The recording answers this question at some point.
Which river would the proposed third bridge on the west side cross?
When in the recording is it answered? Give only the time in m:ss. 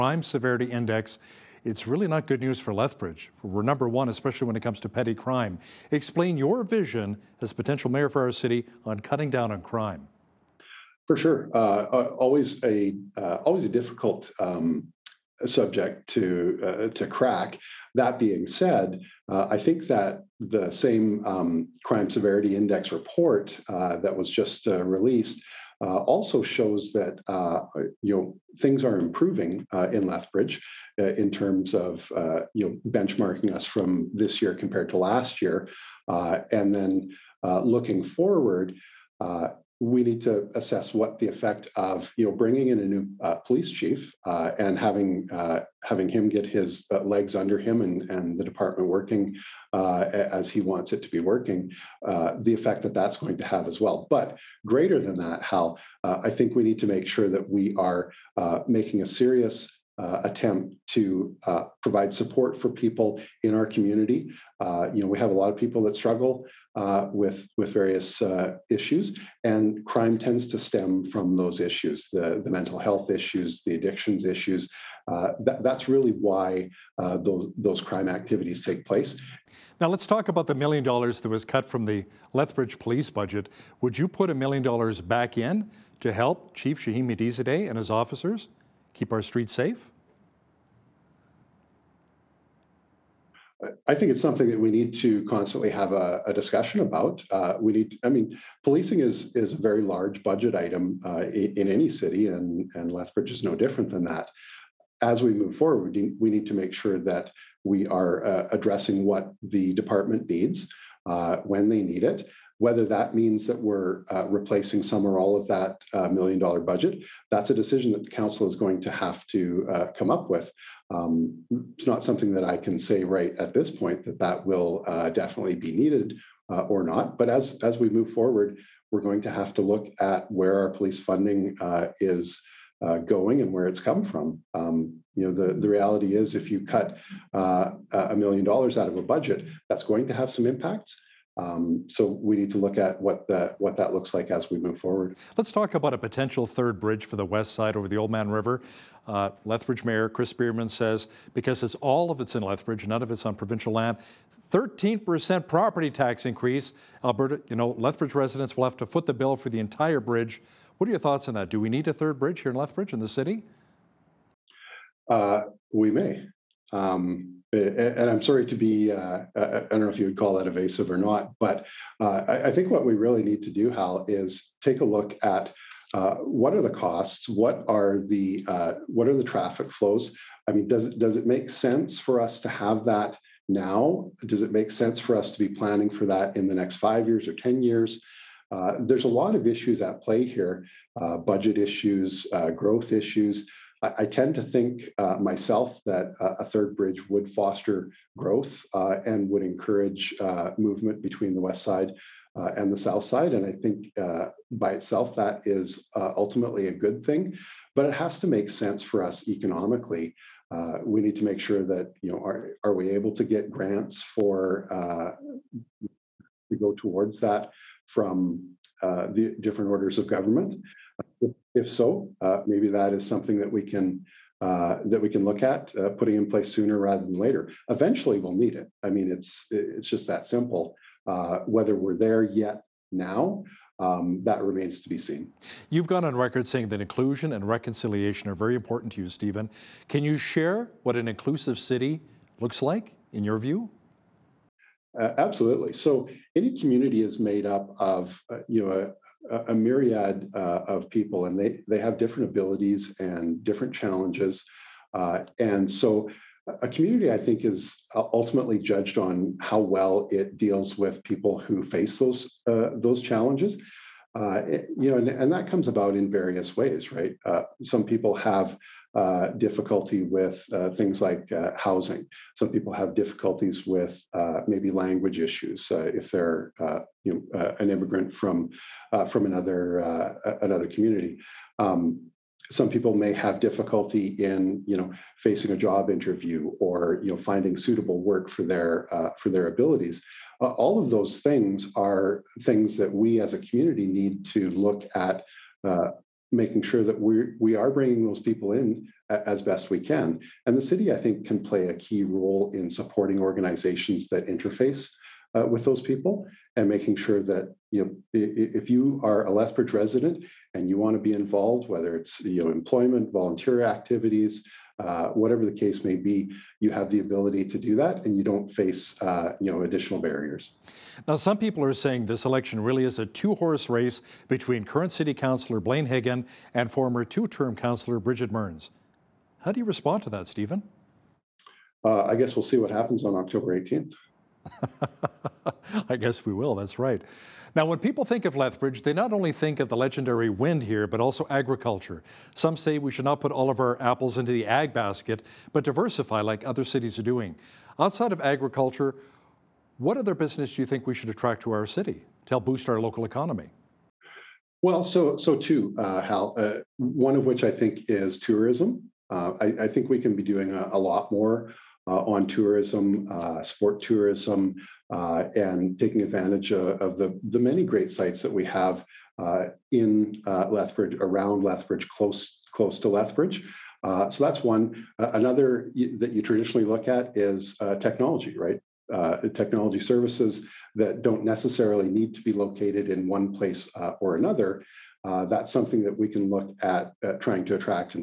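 2:27.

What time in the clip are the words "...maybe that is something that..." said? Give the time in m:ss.
3:42.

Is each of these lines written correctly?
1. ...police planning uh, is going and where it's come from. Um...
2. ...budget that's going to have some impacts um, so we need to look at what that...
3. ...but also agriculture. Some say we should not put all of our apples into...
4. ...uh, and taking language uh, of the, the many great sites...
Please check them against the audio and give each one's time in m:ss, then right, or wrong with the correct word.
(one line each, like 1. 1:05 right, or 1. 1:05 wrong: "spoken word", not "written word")
1. 2:10 wrong: "funding", not "planning"
2. 2:19 right
3. 5:40 right
4. 6:04 wrong: "advantage", not "language".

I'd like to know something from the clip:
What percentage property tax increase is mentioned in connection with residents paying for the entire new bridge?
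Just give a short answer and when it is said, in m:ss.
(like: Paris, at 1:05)
13%, at 2:34.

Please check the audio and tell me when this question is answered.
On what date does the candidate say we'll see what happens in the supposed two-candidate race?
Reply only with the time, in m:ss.
5:33.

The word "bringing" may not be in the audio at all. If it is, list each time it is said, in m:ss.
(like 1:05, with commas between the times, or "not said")
0:42, 4:57.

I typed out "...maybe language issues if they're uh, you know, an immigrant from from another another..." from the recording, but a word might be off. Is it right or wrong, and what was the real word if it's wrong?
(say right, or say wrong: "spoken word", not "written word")
right.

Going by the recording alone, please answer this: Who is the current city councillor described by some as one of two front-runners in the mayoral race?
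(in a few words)
Blaine Hyggen.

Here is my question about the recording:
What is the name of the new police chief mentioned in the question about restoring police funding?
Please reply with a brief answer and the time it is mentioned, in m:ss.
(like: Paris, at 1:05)
Shahin Mehdizadeh, at 1:26.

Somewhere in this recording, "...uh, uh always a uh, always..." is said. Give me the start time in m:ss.
0:11.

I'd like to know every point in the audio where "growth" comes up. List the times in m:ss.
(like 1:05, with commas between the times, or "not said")
3:12, 3:18.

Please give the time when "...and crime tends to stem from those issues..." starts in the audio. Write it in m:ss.
1:09.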